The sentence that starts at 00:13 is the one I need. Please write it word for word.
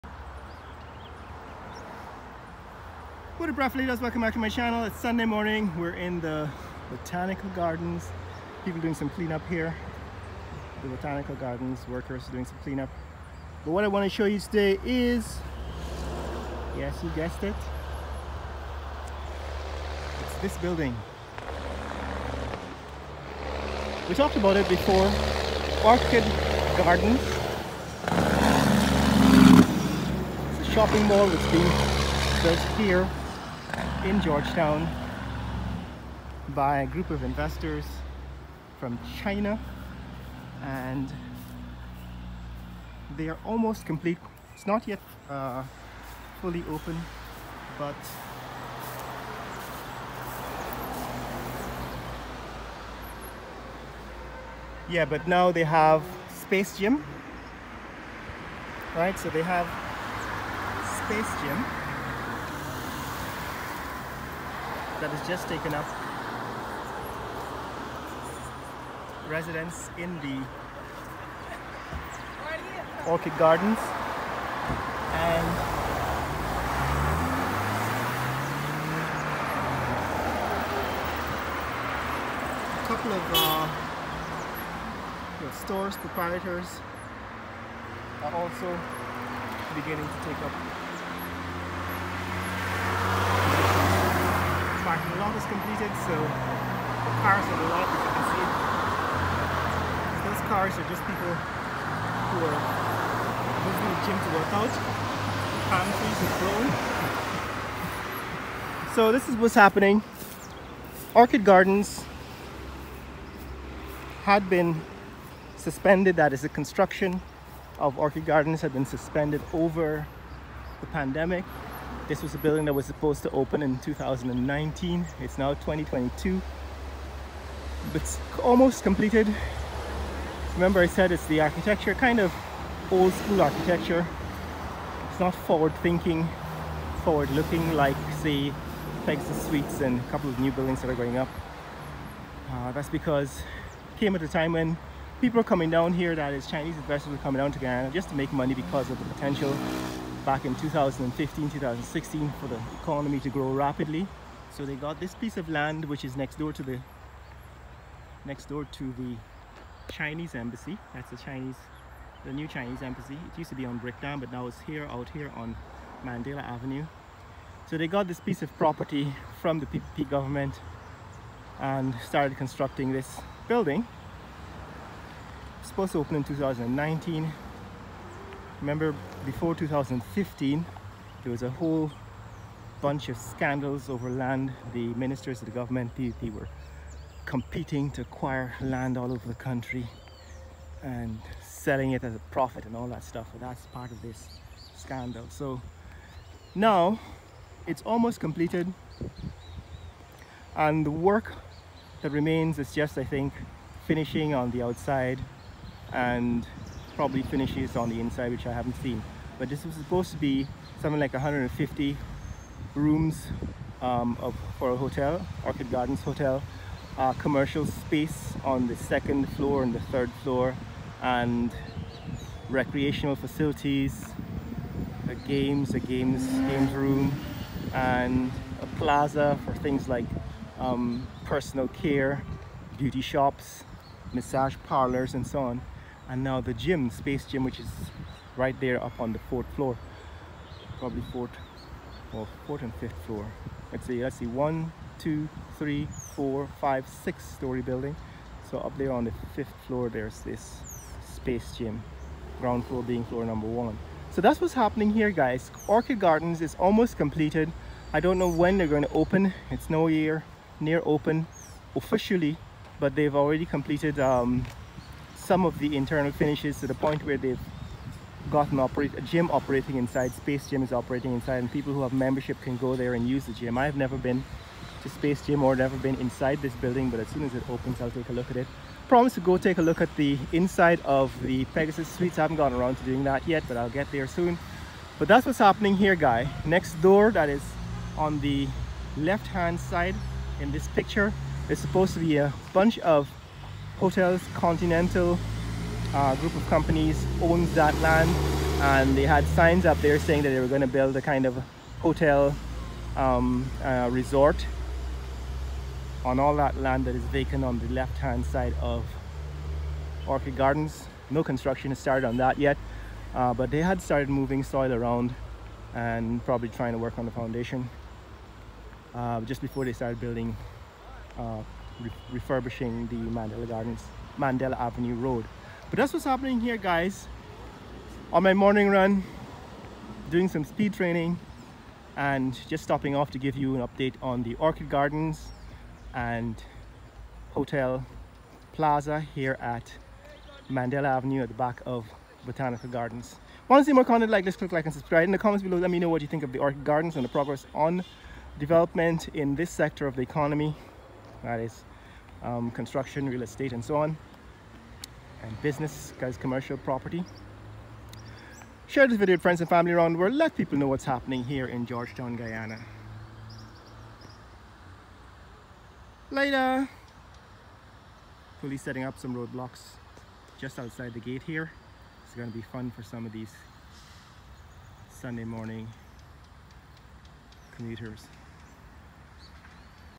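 But what I want to show you today is, yes, you guessed it.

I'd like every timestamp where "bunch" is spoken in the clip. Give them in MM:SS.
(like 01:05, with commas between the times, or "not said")
03:02, 04:52.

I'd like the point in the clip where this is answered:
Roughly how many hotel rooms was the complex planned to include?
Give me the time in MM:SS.
03:31.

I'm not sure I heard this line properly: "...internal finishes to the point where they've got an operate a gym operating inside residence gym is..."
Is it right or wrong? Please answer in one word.
wrong.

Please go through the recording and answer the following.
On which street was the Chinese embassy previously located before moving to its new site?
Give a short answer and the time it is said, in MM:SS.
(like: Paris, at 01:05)
Brickdam, at 02:43.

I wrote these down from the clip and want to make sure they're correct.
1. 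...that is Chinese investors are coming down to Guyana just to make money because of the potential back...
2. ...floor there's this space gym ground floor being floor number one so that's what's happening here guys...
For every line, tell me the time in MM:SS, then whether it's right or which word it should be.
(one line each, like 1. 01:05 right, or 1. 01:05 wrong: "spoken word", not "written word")
1. 02:26 right
2. 04:09 right.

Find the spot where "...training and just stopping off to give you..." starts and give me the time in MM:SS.
05:30.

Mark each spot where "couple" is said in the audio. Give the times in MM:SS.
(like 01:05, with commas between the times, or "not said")
01:22, 02:20.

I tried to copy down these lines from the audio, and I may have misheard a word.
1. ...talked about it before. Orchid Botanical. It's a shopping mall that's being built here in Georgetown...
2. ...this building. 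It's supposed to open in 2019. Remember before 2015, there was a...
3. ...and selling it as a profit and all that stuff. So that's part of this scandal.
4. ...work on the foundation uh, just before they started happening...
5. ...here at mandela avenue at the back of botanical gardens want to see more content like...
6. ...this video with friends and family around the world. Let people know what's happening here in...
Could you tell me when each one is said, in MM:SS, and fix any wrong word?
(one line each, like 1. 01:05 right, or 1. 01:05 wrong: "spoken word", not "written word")
1. 00:24 wrong: "Gardens", not "Botanical"
2. 02:52 right
3. 03:10 right
4. 05:16 wrong: "building", not "happening"
5. 05:39 right
6. 05:58 right.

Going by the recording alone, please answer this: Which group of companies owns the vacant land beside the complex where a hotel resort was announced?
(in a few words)
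Continental.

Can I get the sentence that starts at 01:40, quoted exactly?
Those cars are just people who are going to the gym to work out.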